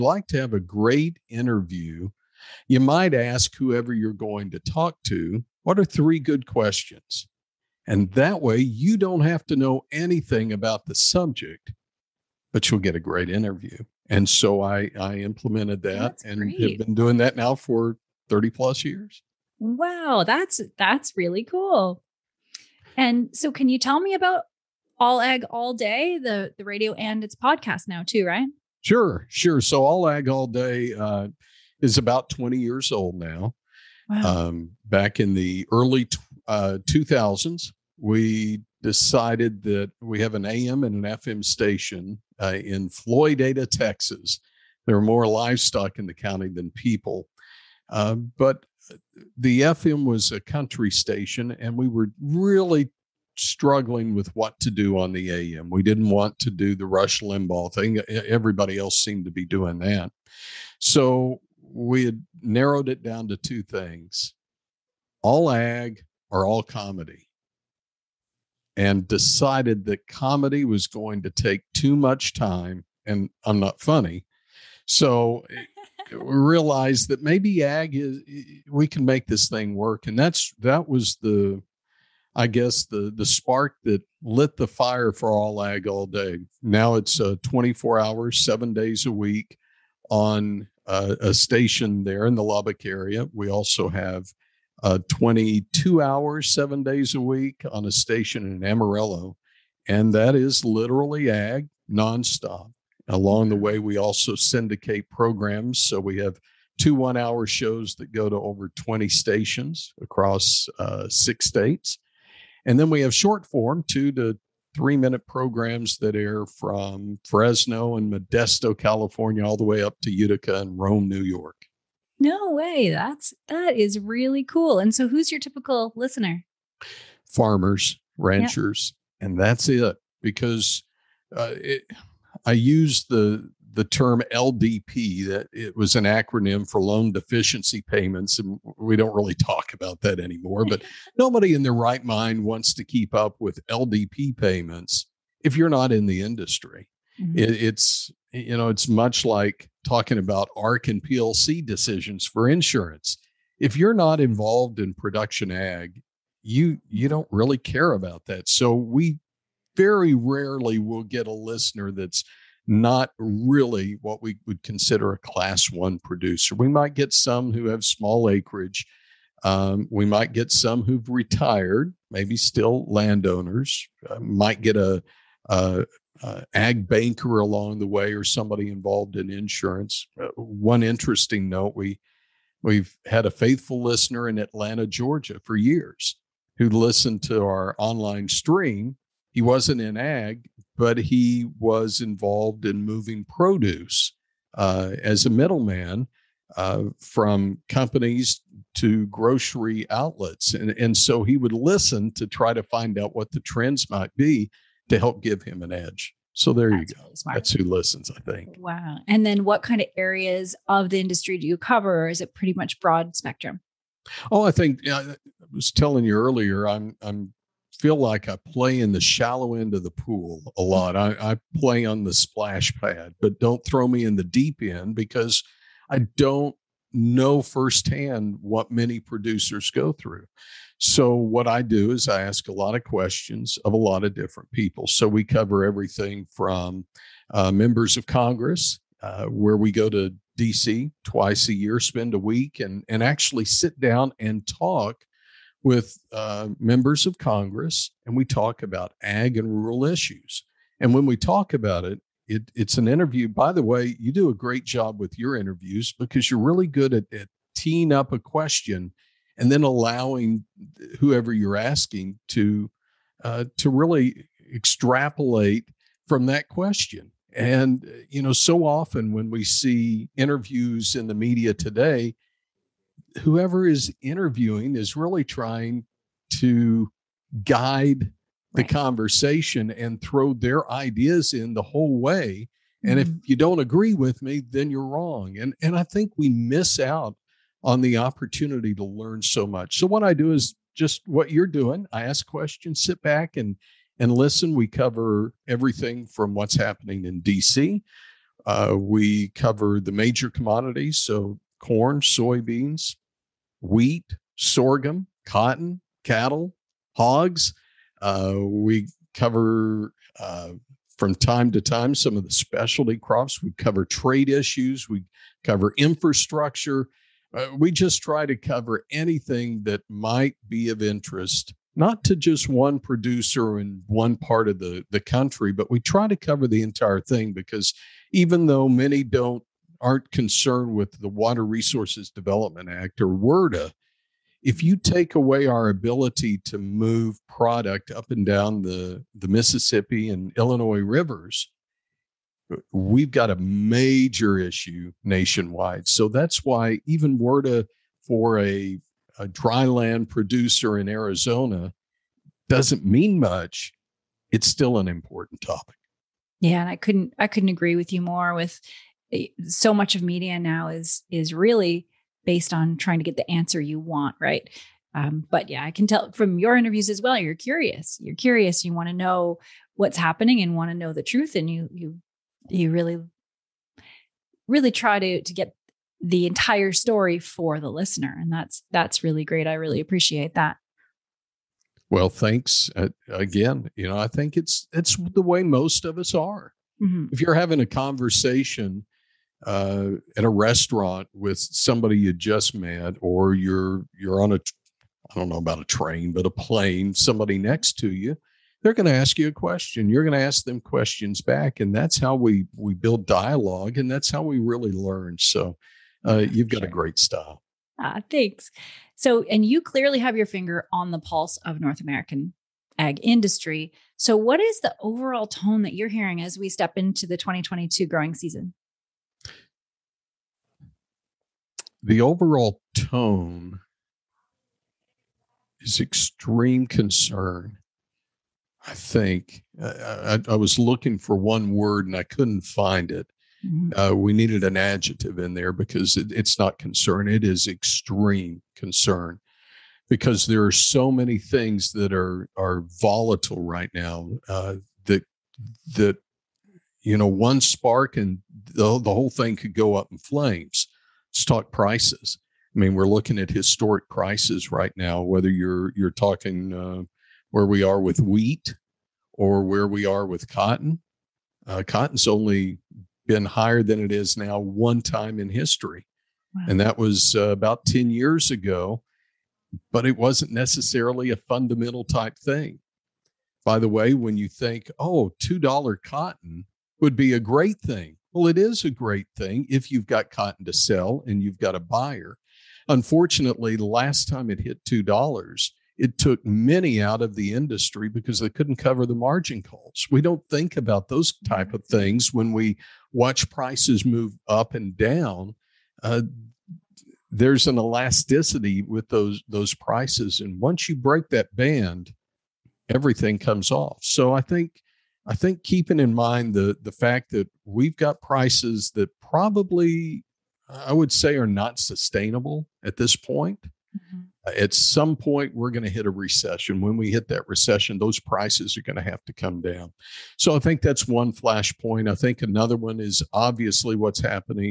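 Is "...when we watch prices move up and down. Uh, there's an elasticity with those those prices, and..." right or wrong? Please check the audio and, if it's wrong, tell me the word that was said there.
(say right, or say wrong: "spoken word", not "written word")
right.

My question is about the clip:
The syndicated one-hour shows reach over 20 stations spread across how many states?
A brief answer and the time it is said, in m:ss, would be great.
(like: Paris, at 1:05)
6, at 1:51.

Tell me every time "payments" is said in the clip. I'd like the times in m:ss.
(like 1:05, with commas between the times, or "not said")
2:17, 2:24.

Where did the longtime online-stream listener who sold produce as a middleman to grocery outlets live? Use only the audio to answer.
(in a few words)
Atlanta, Georgia.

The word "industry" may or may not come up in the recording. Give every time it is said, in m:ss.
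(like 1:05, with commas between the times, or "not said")
2:26, 3:30, 6:53, 8:07.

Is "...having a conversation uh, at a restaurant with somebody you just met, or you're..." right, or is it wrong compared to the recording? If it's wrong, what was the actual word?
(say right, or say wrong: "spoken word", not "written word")
right.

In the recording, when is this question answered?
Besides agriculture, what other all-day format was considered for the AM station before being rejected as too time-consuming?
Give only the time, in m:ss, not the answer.
1:06.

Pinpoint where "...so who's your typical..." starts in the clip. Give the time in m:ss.
2:04.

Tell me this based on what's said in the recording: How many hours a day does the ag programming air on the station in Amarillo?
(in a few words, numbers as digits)
22.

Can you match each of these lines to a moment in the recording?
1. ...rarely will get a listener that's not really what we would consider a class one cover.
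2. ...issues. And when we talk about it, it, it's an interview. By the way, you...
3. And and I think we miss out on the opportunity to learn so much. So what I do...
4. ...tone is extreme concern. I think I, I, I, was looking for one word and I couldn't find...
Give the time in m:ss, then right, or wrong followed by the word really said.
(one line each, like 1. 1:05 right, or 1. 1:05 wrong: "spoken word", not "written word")
1. 2:40 wrong: "producer", not "cover"
2. 4:09 right
3. 4:45 right
4. 7:02 right.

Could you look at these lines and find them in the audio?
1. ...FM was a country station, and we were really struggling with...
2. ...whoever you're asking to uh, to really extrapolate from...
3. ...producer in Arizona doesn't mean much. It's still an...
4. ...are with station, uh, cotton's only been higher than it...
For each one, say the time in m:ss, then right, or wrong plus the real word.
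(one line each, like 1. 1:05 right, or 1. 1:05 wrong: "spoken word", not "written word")
1. 0:49 right
2. 4:20 right
3. 5:50 right
4. 7:39 wrong: "cotton", not "station".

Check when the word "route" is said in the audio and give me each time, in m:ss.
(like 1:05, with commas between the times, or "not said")
not said.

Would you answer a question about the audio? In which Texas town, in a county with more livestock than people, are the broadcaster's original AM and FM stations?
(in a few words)
Floydada.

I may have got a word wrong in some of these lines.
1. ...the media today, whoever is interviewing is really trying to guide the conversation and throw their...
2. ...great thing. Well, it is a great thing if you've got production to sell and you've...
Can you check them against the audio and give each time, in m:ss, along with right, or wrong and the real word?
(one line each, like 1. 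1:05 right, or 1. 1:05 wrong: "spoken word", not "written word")
1. 4:31 right
2. 7:57 wrong: "cotton", not "production".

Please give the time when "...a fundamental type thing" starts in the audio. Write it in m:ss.
7:51.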